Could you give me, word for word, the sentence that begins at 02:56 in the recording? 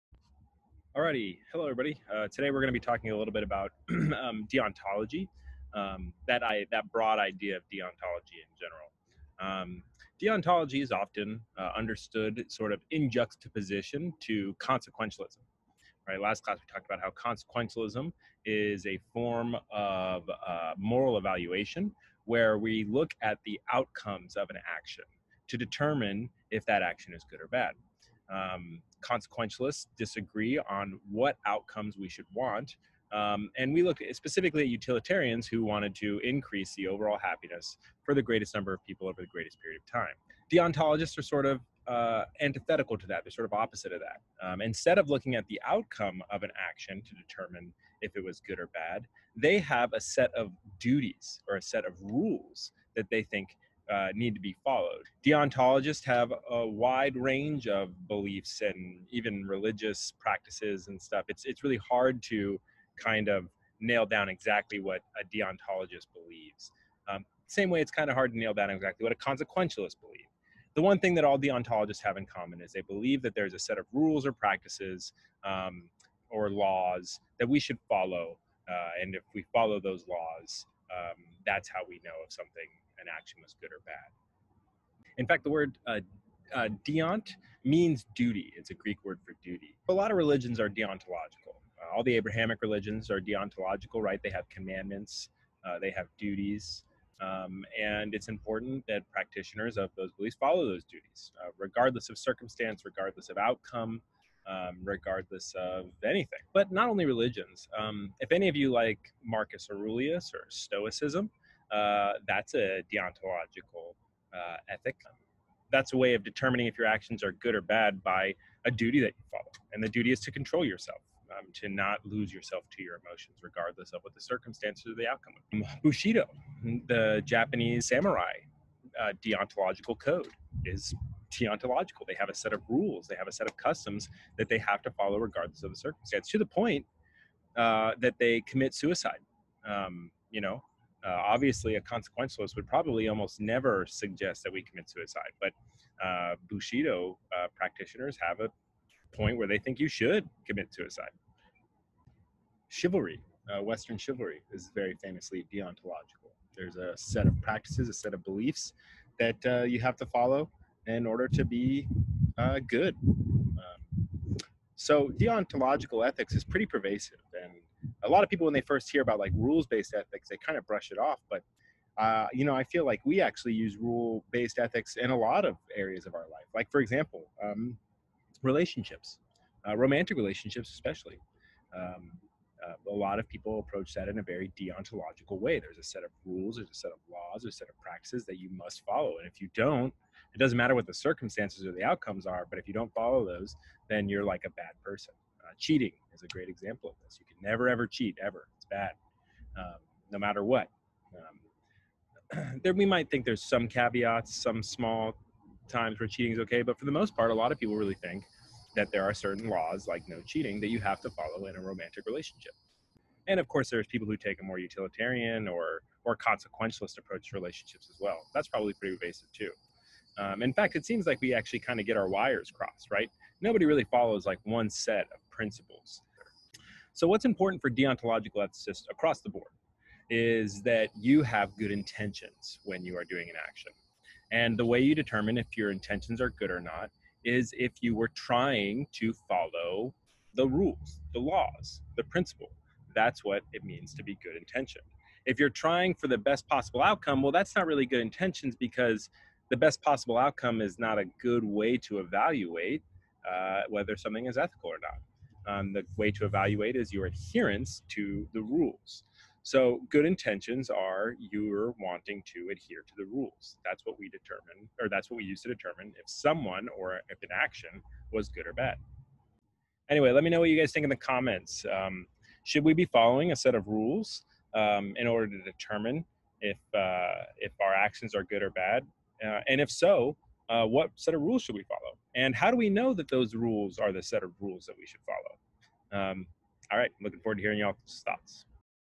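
Like for example, um, relationships, uh, romantic relationships especially.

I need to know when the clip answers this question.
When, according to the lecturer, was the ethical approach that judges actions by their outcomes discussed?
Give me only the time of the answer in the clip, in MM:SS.
00:16.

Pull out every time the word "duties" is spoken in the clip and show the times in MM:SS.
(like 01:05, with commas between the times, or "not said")
00:50, 01:36, 01:40.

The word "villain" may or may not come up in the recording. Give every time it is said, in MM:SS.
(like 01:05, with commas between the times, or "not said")
not said.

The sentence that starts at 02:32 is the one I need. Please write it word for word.
Chivalry, uh, Western chivalry, is very famously deontological.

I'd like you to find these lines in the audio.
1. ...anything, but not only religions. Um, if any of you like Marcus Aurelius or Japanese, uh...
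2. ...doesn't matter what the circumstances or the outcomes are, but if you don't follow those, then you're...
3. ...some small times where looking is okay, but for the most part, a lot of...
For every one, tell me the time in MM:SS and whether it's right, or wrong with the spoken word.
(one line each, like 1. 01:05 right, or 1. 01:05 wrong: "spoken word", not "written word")
1. 01:46 wrong: "Stoicism", not "Japanese"
2. 03:10 right
3. 03:24 wrong: "cheating", not "looking".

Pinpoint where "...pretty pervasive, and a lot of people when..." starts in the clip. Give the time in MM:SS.
02:46.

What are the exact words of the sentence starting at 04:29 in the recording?
Anyway, let me know what you guys think in the comments.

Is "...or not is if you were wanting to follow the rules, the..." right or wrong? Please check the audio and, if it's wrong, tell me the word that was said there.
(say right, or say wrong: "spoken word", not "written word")
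wrong: "trying", not "wanting".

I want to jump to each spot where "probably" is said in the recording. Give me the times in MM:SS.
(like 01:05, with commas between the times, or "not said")
02:22, 03:38.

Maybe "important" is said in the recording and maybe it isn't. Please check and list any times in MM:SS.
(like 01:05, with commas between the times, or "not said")
01:38, 03:47.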